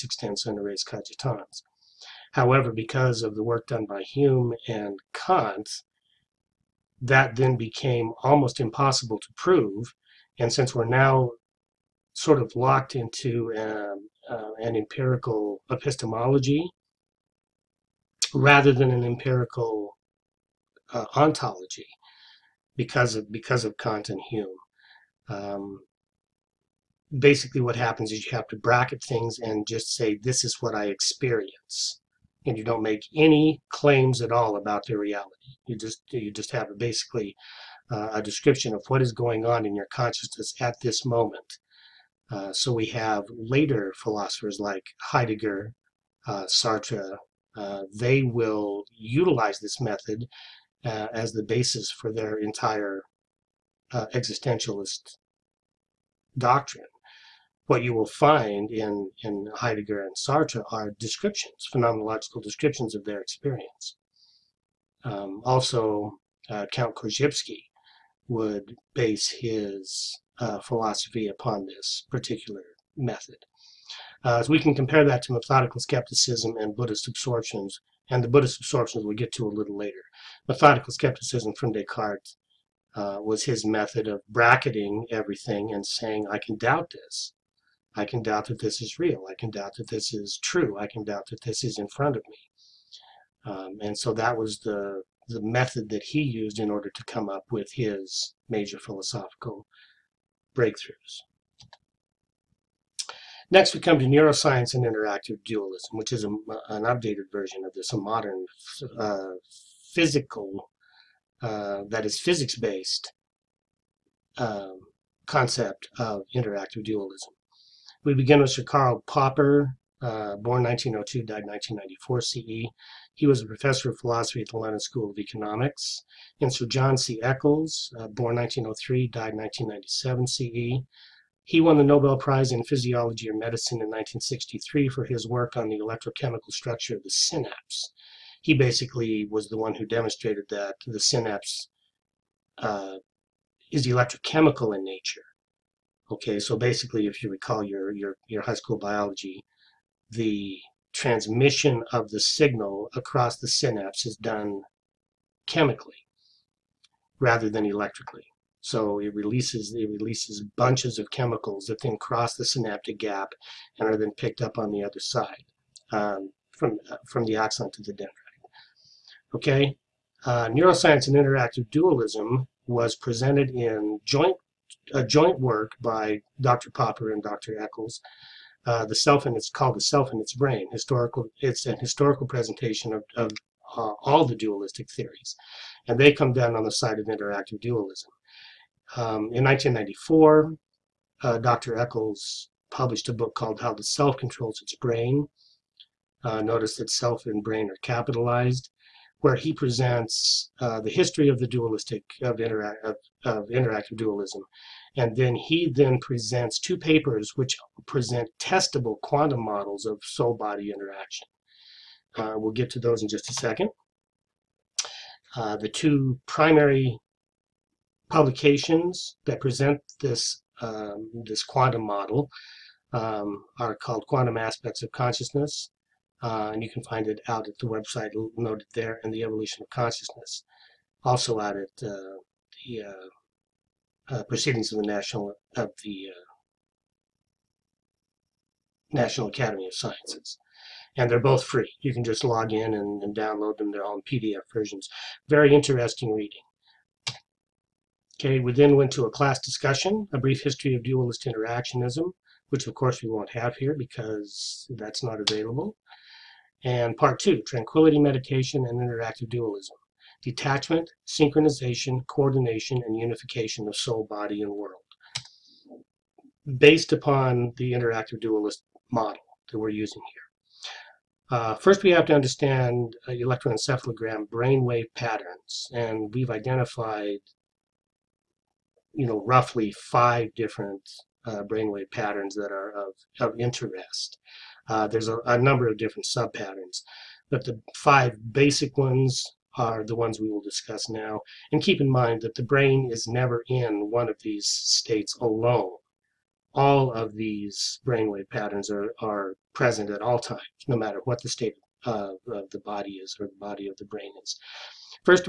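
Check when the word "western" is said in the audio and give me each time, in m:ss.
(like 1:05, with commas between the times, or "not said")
not said.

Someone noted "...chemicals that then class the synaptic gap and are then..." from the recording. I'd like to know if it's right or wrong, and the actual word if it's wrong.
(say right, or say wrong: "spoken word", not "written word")
wrong: "cross", not "class".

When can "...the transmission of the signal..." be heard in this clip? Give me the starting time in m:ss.
2:30.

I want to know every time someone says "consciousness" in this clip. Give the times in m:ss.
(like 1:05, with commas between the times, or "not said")
0:39, 3:44, 3:49.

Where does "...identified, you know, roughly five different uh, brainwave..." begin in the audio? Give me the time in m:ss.
4:36.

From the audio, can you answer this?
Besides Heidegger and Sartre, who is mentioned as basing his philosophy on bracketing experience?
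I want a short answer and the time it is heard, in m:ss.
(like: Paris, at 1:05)
Korzybski, at 1:06.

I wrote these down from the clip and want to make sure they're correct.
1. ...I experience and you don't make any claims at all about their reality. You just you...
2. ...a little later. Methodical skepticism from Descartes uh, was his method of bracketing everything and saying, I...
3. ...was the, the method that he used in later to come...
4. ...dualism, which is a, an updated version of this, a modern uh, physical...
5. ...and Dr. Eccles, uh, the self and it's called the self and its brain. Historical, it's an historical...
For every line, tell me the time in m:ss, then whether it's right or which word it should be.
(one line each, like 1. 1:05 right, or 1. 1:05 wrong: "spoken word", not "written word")
1. 0:30 right
2. 1:19 right
3. 1:34 wrong: "order", not "later"
4. 1:45 right
5. 2:57 right.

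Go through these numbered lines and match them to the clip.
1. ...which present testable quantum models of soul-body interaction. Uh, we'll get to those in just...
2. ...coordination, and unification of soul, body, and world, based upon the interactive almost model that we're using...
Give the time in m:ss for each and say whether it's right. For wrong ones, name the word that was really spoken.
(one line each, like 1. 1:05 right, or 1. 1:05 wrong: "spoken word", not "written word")
1. 3:27 right
2. 4:22 wrong: "dualist", not "almost".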